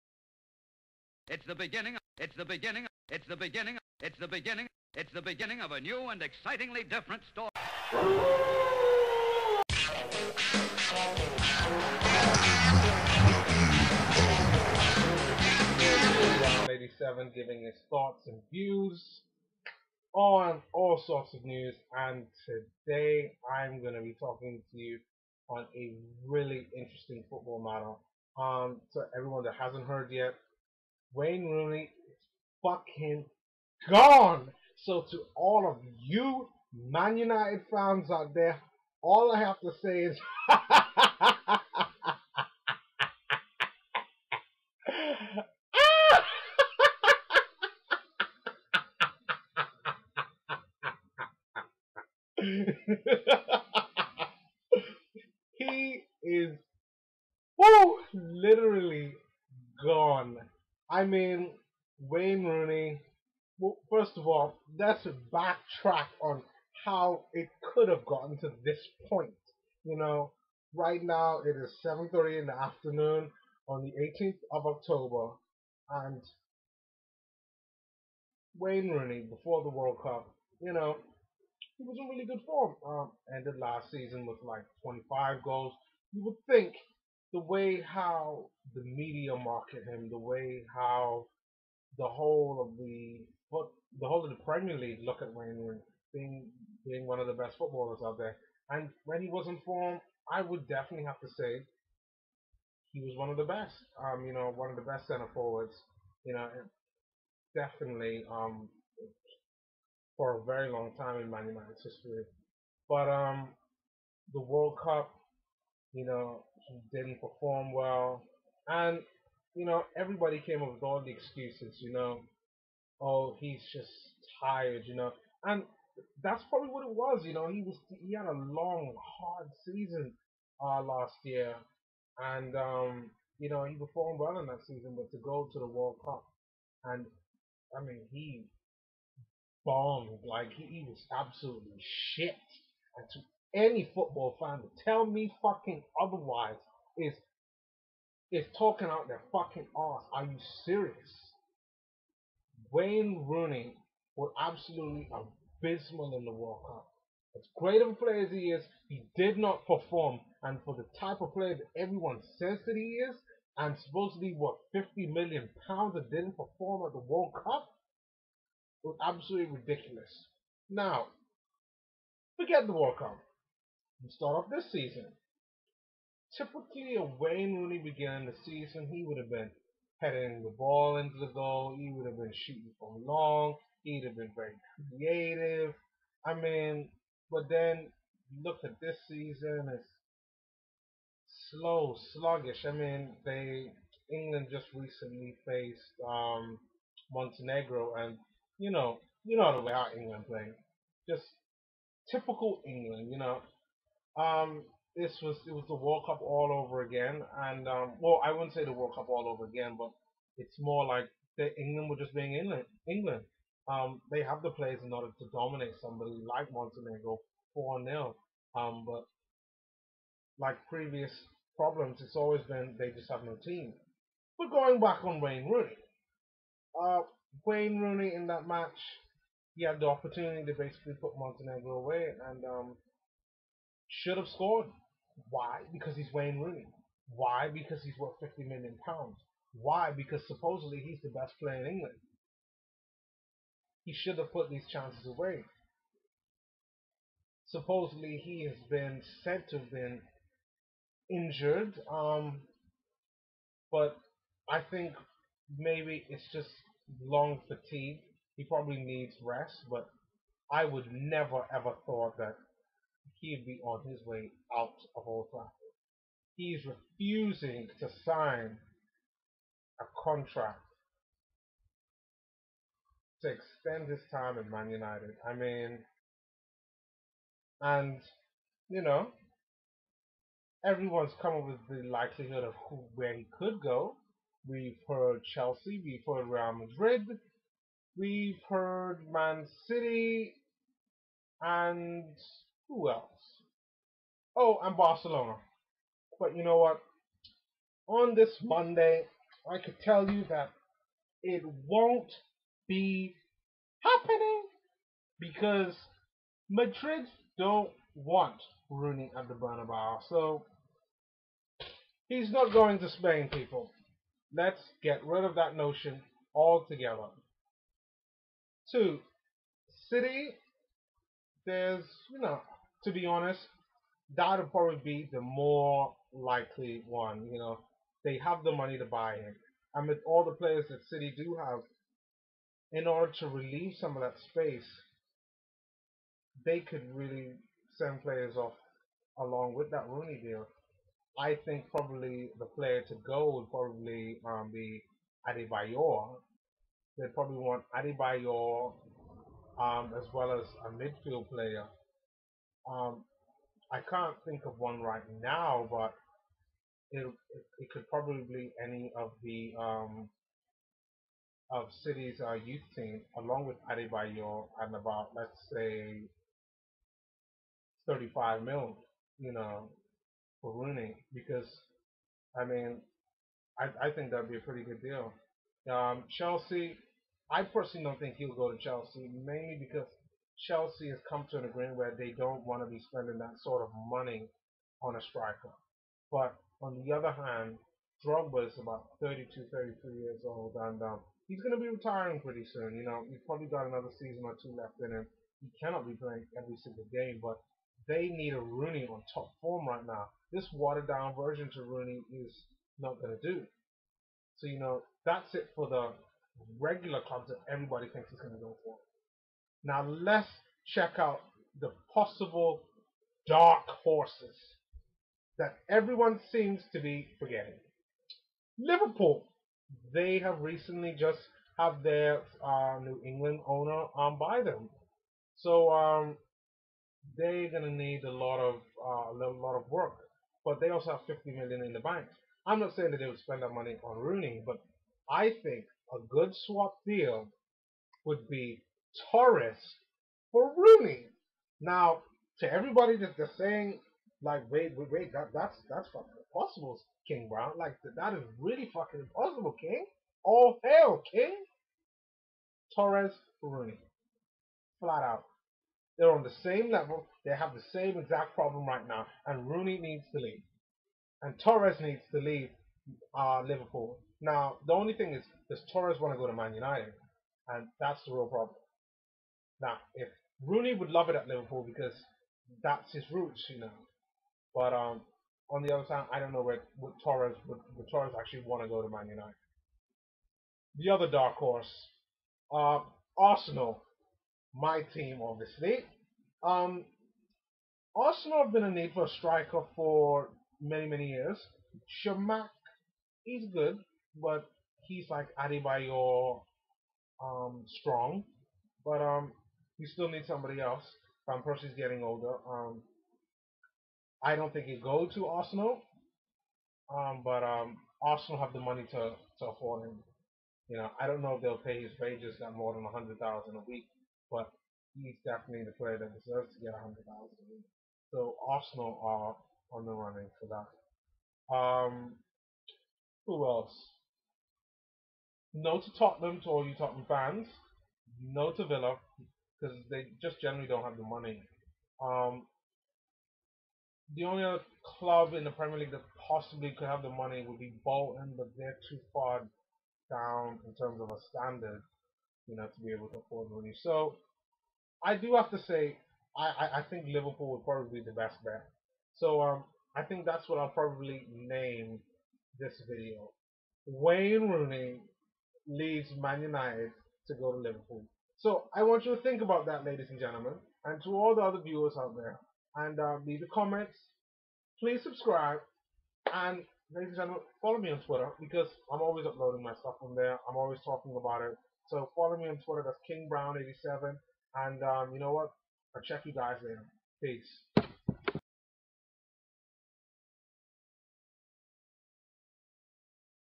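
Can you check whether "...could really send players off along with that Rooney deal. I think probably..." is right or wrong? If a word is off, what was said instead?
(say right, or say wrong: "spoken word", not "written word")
right.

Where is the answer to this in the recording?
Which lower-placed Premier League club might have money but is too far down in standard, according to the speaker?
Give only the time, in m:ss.
8:57.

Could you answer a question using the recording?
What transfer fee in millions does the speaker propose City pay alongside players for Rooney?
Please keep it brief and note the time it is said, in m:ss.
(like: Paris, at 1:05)
35 million, at 6:07.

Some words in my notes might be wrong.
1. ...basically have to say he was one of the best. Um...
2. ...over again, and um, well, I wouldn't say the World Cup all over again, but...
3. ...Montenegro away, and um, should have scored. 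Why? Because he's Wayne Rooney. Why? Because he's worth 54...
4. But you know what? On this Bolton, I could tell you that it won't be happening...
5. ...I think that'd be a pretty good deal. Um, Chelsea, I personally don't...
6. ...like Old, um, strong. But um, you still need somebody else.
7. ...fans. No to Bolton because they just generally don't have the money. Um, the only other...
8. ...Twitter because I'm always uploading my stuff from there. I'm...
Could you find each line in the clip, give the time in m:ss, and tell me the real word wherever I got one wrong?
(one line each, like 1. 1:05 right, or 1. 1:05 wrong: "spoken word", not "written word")
1. 1:40 wrong: "definitely", not "basically"
2. 3:26 right
3. 3:51 wrong: "50", not "54"
4. 4:56 wrong: "Monday", not "Bolton"
5. 6:13 right
6. 8:15 wrong: "Adebayor", not "Old"
7. 8:47 wrong: "Villa", not "Bolton"
8. 9:28 right.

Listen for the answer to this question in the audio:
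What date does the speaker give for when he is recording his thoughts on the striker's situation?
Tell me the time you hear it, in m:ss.
1:13.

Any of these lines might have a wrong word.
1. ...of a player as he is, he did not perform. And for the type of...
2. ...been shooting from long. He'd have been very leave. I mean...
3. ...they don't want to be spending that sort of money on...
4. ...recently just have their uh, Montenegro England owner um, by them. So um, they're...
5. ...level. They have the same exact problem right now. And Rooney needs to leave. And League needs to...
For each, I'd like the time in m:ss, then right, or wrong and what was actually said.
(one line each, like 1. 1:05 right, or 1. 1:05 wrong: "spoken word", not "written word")
1. 2:37 right
2. 3:02 wrong: "creative", not "leave"
3. 6:21 right
4. 7:00 wrong: "New", not "Montenegro"
5. 7:36 wrong: "Torres", not "League".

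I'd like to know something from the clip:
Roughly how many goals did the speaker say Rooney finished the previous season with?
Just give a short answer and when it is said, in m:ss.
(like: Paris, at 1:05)
25, at 1:24.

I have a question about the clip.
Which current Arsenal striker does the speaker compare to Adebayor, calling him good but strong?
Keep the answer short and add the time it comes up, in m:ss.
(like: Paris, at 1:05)
Chamakh, at 8:12.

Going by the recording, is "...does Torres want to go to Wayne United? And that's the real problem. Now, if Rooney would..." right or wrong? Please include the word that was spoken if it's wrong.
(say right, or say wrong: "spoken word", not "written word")
wrong: "Man", not "Wayne".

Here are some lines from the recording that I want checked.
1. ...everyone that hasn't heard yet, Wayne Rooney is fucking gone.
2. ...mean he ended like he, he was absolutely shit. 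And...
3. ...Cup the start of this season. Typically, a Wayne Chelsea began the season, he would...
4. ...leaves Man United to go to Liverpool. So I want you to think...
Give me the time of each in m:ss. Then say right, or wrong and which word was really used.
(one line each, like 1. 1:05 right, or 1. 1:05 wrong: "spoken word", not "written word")
1. 0:29 right
2. 2:17 wrong: "bombed", not "ended"
3. 2:52 wrong: "Rooney", not "Chelsea"
4. 9:15 right.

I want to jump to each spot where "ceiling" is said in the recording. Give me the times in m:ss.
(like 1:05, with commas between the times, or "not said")
not said.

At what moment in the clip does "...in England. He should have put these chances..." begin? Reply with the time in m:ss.
4:01.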